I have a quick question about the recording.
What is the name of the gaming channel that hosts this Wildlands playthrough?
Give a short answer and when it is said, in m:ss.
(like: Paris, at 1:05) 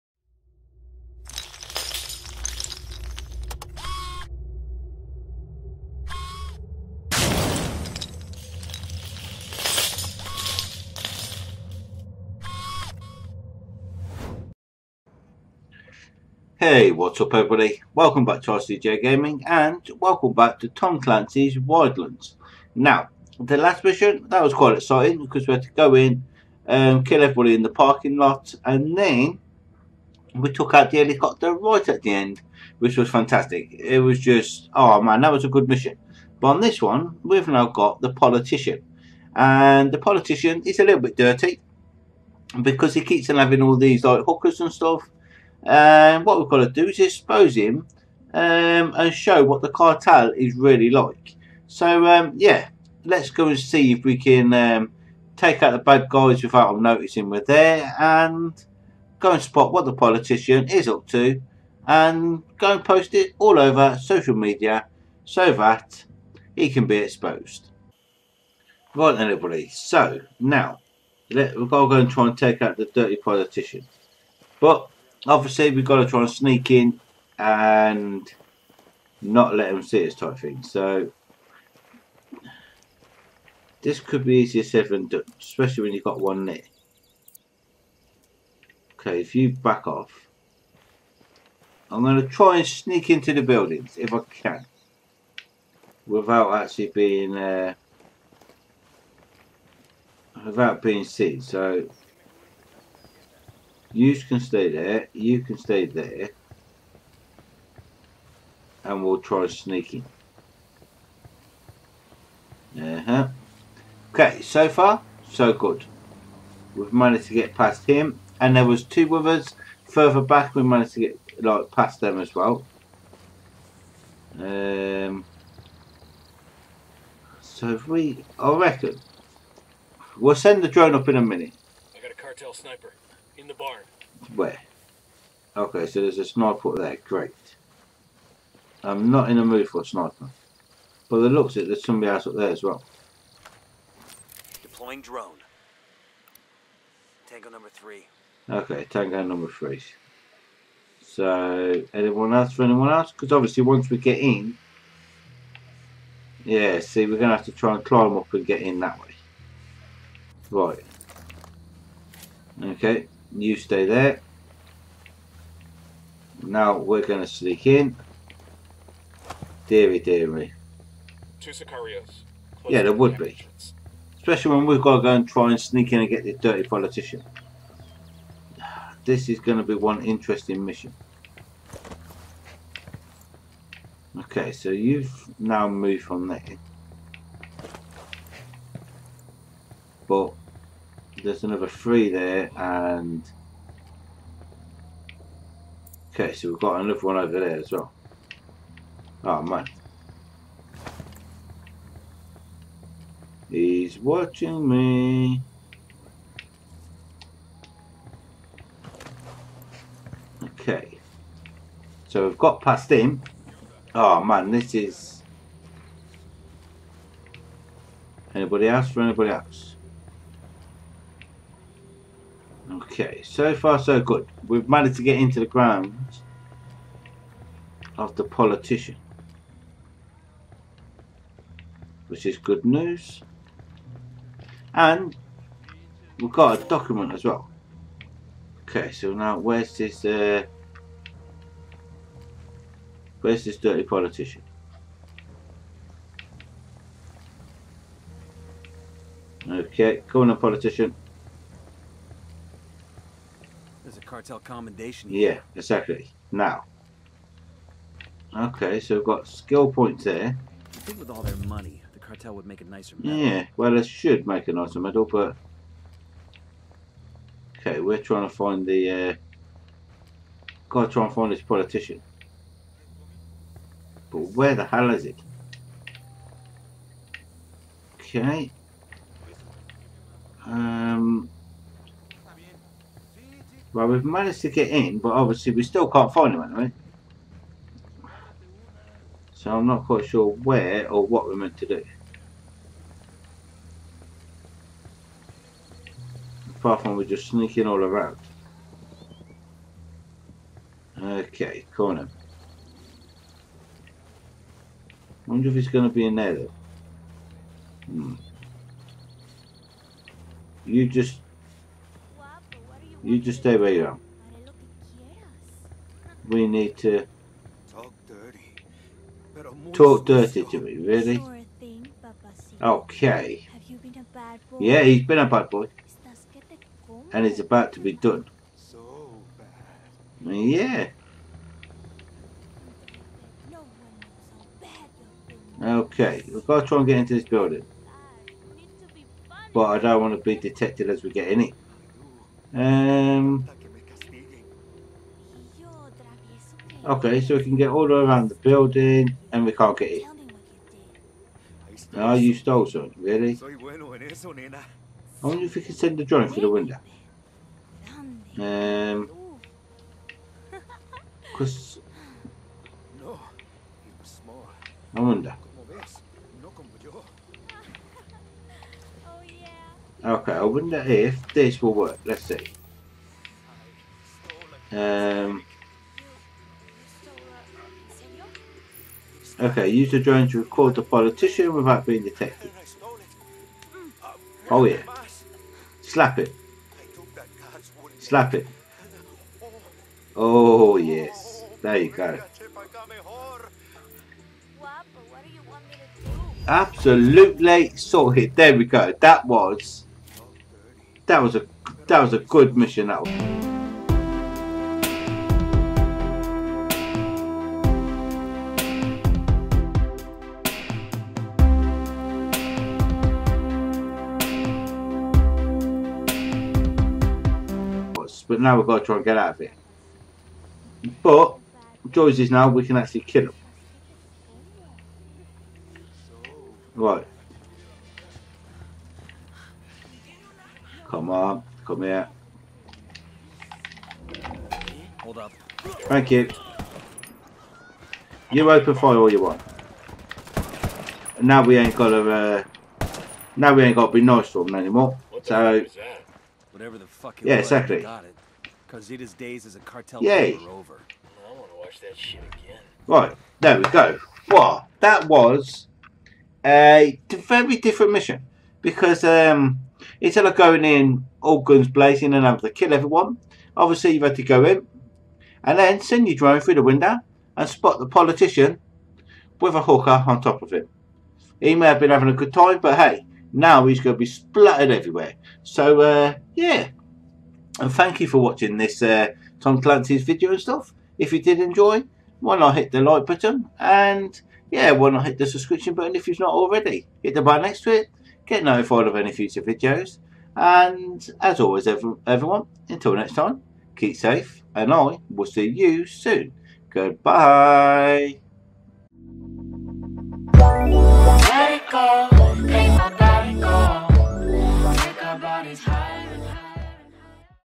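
RCJ Gaming, at 0:18.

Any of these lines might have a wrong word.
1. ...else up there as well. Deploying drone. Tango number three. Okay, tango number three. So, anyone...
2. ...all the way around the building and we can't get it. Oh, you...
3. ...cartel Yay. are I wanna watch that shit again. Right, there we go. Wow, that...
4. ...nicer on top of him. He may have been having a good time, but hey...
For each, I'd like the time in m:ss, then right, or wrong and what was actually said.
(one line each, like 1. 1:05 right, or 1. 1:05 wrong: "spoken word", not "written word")
1. 2:22 right
2. 5:47 right
3. 7:29 right
4. 7:49 wrong: "hooker", not "nicer".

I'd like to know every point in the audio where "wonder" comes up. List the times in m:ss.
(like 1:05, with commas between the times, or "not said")
5:05, 5:55, 6:04, 6:10.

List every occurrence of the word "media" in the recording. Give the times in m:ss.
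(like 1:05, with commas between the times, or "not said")
1:04.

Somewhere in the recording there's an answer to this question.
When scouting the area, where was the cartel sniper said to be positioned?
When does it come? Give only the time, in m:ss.
2:13.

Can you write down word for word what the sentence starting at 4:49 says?
So I'm not quite sure where or what we're meant to do.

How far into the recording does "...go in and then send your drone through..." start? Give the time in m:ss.
7:44.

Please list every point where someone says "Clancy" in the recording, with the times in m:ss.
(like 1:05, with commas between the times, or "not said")
0:21, 7:59.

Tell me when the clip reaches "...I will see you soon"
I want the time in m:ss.
8:14.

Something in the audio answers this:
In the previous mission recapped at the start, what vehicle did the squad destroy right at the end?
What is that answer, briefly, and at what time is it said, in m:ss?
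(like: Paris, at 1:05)
The helicopter, at 0:30.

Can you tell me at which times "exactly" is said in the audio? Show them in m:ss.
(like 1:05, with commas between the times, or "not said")
4:15, 7:27.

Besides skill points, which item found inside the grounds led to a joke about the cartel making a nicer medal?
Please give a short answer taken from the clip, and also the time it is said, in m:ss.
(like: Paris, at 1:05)
Cartel commendation, at 4:14.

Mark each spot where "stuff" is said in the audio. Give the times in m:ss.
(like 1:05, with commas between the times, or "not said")
0:44, 8:00.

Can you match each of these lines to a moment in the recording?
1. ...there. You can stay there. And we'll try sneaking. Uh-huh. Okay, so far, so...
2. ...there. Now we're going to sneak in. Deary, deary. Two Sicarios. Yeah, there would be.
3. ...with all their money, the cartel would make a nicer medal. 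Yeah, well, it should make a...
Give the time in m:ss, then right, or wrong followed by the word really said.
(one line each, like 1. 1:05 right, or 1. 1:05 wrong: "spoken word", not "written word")
1. 1:44 right
2. 2:43 right
3. 4:20 right.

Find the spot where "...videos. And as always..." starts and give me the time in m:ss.
8:09.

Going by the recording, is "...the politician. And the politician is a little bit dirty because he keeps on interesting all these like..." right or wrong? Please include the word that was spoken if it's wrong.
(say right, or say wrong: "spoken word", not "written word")
wrong: "having", not "interesting".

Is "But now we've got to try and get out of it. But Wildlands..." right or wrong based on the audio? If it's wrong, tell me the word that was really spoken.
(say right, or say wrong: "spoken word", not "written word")
wrong: "Joyce", not "Wildlands".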